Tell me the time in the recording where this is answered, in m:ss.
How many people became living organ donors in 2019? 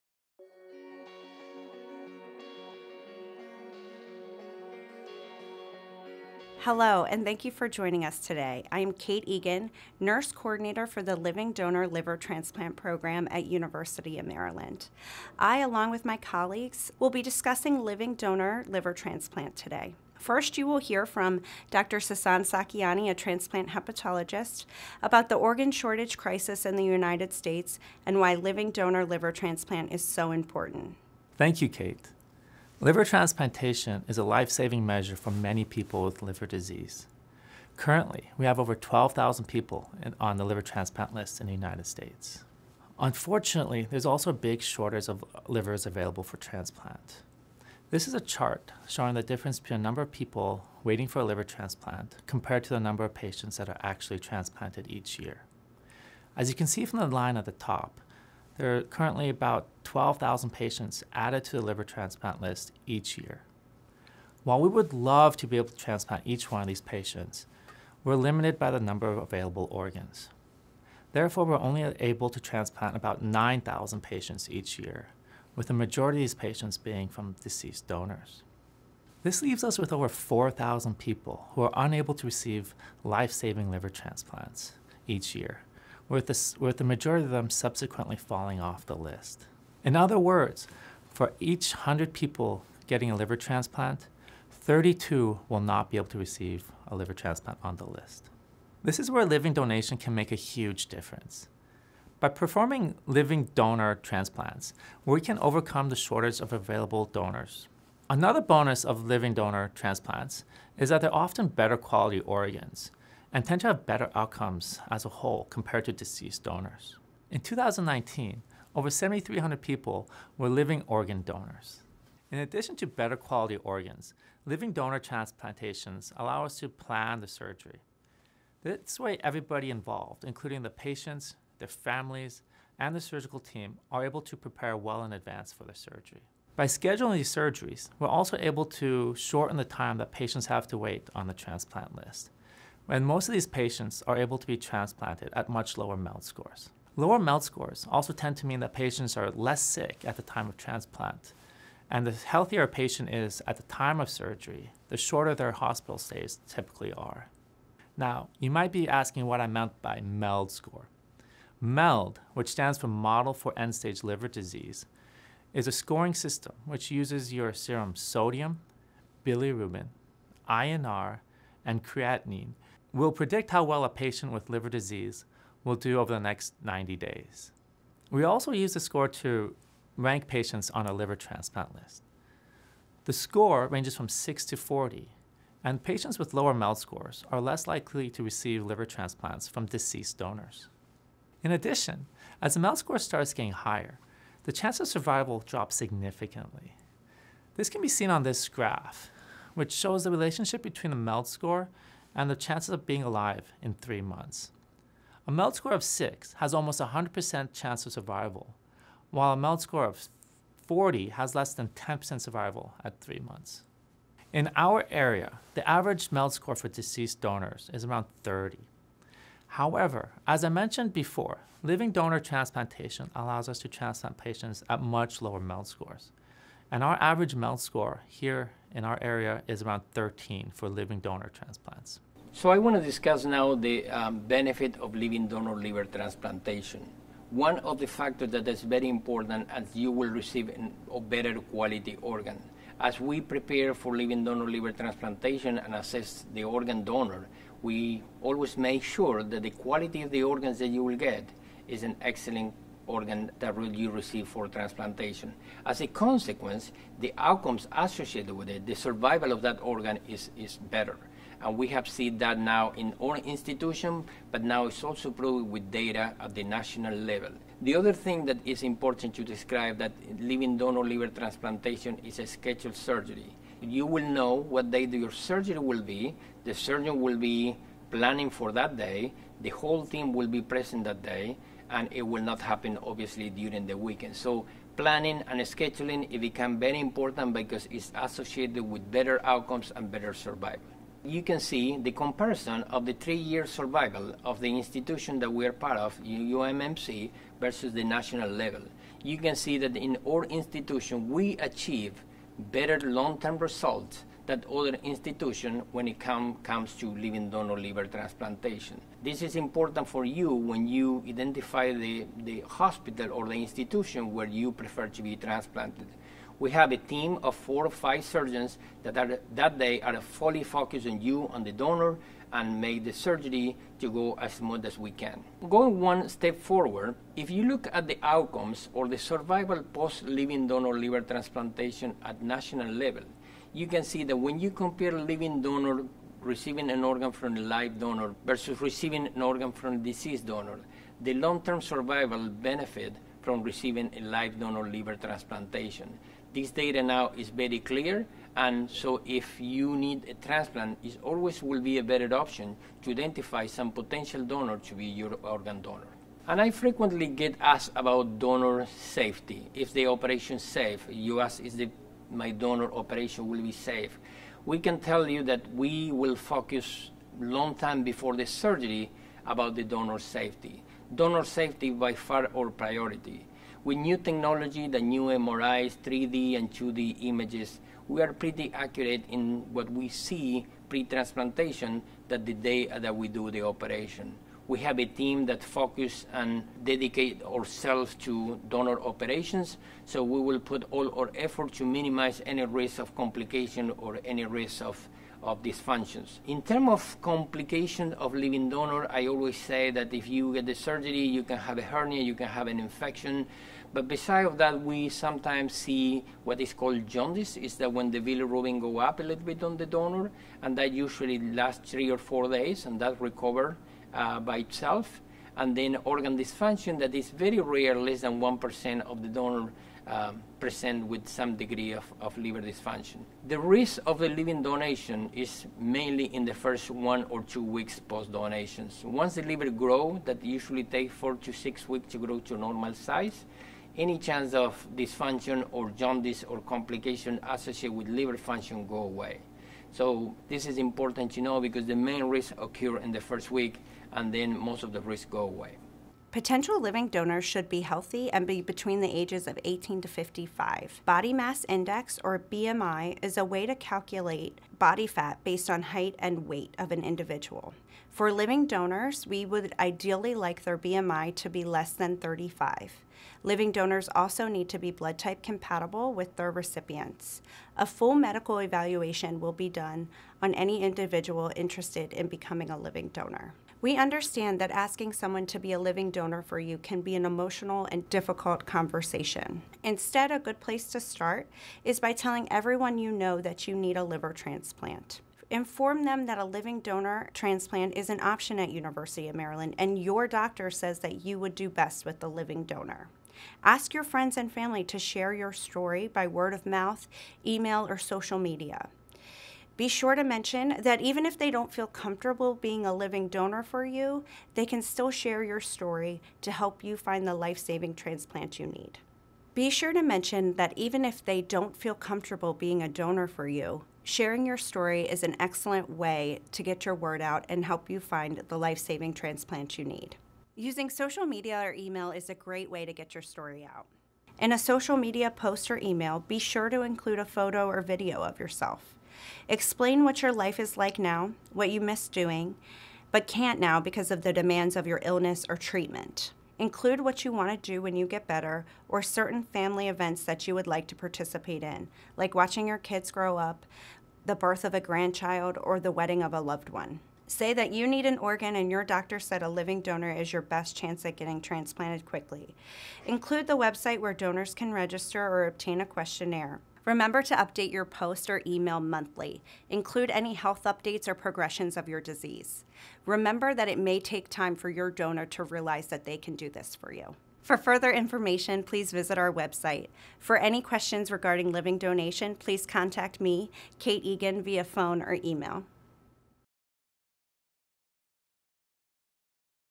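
1:58.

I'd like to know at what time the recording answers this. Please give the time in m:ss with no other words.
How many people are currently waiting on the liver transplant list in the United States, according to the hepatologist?
0:38.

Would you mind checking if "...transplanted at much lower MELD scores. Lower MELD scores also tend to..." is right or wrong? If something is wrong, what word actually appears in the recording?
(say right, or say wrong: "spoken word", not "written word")
right.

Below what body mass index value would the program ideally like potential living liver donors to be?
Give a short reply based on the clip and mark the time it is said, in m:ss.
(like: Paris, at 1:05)
35, at 7:41.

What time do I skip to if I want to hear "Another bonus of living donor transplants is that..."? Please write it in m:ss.
1:48.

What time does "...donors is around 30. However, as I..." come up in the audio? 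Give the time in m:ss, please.
3:37.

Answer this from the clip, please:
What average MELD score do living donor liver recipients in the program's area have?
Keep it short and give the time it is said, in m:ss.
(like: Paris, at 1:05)
13, at 3:49.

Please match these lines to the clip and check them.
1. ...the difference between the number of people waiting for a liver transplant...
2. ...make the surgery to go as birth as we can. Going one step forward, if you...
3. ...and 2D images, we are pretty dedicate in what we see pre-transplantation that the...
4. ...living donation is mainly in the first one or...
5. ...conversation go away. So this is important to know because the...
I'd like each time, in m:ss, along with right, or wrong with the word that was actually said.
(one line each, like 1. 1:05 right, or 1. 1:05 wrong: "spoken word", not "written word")
1. 0:49 right
2. 5:22 wrong: "smooth", not "birth"
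3. 6:16 wrong: "accurate", not "dedicate"
4. 7:04 right
5. 7:18 wrong: "function", not "conversation".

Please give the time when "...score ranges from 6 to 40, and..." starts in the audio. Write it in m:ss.
3:03.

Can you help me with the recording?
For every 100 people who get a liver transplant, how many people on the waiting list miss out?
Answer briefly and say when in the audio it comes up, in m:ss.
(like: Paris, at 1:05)
32, at 1:34.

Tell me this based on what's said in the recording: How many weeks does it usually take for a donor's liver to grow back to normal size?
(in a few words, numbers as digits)
4 to 6 weeks.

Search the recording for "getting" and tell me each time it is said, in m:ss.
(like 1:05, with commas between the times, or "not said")
1:32, 3:13, 9:10.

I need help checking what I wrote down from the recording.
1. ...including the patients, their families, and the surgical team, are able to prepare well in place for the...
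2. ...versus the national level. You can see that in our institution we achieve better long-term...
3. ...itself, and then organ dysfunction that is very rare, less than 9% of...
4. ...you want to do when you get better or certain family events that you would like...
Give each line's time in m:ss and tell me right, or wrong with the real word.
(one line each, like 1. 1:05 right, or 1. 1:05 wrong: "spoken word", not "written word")
1. 2:10 wrong: "advance", not "place"
2. 4:57 right
3. 6:54 wrong: "1", not "9"
4. 8:57 right.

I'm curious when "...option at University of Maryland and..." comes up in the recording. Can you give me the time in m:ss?
8:08.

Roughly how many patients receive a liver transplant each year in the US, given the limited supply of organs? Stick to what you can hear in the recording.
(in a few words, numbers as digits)
9,000.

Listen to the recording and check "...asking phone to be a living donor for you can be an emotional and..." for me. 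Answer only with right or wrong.
wrong.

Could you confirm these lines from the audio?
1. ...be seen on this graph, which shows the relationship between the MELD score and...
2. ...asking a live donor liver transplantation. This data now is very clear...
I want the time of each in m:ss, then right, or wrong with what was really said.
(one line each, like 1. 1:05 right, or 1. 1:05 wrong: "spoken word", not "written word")
1. 3:17 right
2. 5:43 wrong: "receiving", not "asking".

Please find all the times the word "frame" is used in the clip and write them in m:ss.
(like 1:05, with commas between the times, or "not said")
not said.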